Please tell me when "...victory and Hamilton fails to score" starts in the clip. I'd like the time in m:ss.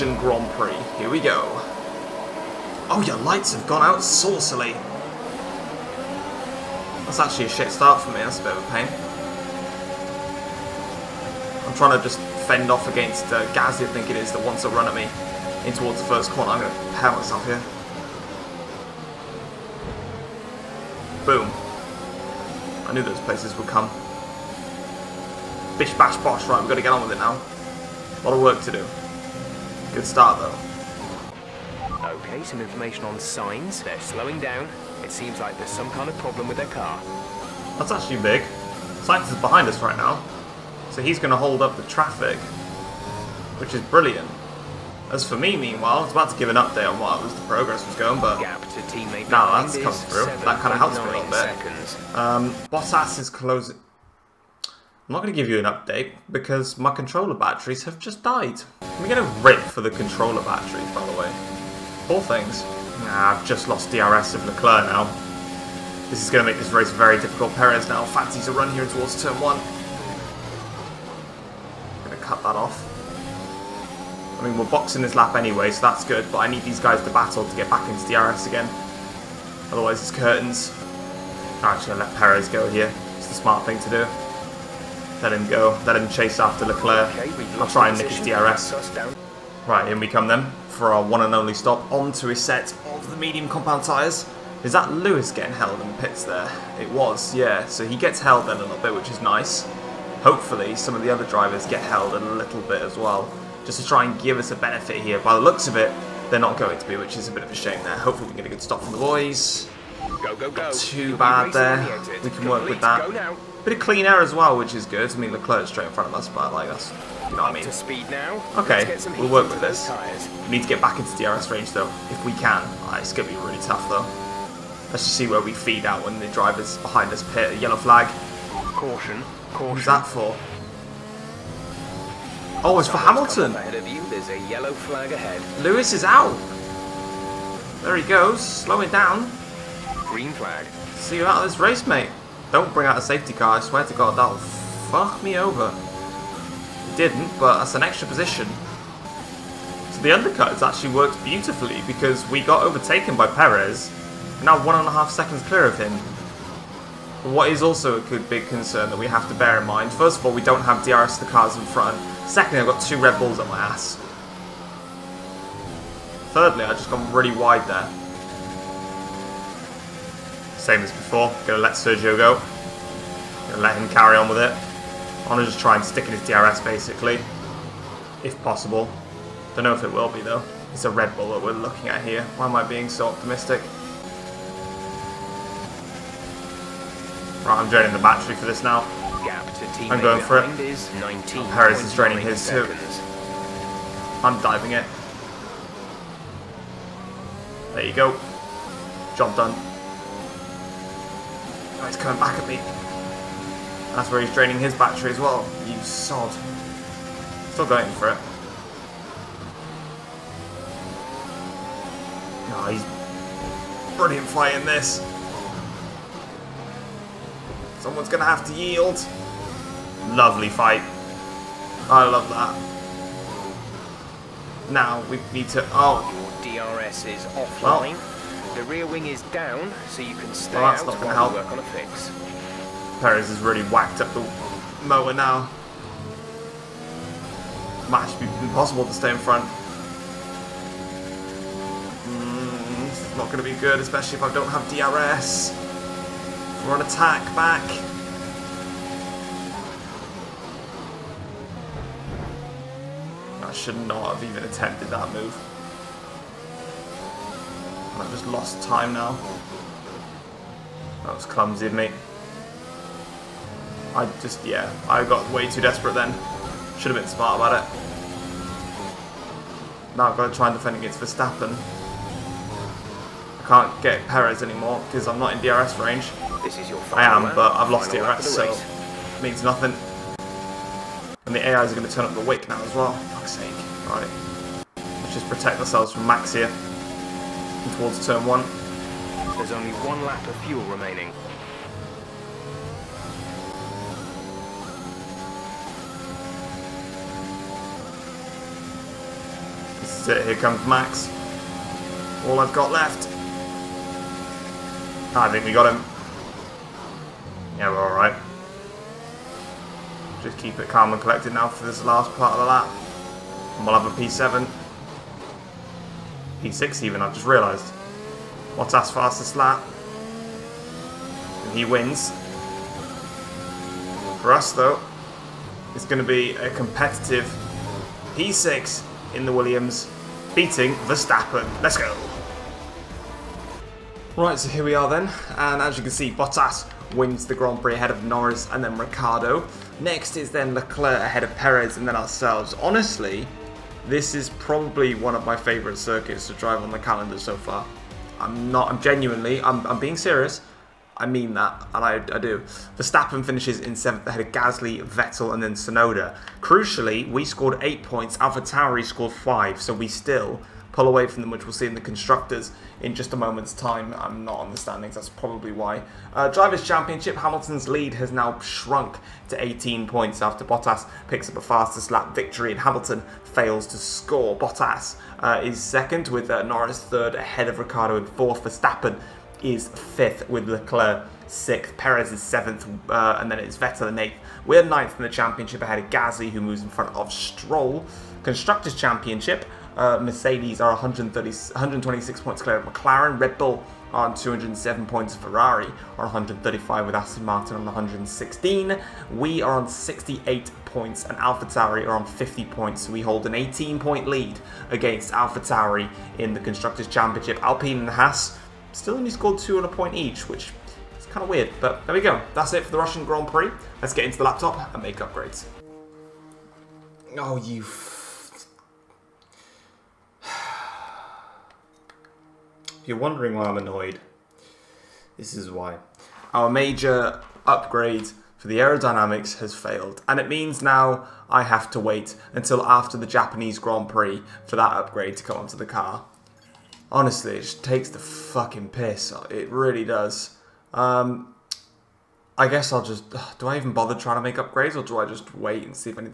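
6:12.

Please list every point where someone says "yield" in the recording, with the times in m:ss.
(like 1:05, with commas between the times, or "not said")
3:38.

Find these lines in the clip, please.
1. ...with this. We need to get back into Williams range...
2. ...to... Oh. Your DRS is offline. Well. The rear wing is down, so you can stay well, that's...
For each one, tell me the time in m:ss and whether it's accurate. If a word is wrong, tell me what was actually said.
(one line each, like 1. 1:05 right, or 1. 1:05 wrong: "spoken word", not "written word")
1. 1:59 wrong: "DRS", not "Williams"
2. 3:45 right.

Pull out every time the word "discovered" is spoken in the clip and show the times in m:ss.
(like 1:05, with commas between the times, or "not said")
not said.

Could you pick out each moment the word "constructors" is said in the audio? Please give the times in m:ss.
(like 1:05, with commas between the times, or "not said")
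6:01, 6:28, 6:46.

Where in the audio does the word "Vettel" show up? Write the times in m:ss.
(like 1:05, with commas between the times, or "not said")
5:54, 6:23.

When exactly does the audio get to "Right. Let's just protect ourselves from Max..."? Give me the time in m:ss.
4:43.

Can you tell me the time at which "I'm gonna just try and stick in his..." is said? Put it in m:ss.
2:55.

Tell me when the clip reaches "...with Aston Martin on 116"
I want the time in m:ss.
6:36.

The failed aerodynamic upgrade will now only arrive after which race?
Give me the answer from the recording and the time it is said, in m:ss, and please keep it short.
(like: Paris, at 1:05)
Japanese Grand Prix, at 7:13.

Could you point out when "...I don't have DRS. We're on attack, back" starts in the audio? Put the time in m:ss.
4:04.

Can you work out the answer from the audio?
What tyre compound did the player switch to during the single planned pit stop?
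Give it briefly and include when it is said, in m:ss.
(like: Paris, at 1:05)
Medium, at 1:33.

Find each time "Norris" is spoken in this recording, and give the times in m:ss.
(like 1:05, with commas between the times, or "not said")
5:38, 6:16.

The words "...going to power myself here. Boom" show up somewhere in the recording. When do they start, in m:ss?
0:16.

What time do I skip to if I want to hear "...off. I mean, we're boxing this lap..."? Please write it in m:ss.
1:12.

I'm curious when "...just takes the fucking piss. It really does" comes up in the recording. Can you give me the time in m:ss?
7:17.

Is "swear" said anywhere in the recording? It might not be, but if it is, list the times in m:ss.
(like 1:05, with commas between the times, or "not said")
2:23.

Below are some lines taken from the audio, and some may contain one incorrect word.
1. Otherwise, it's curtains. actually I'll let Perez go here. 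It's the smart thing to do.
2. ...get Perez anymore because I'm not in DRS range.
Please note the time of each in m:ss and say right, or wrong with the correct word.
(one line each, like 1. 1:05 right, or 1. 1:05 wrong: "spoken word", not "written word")
1. 1:19 right
2. 4:33 right.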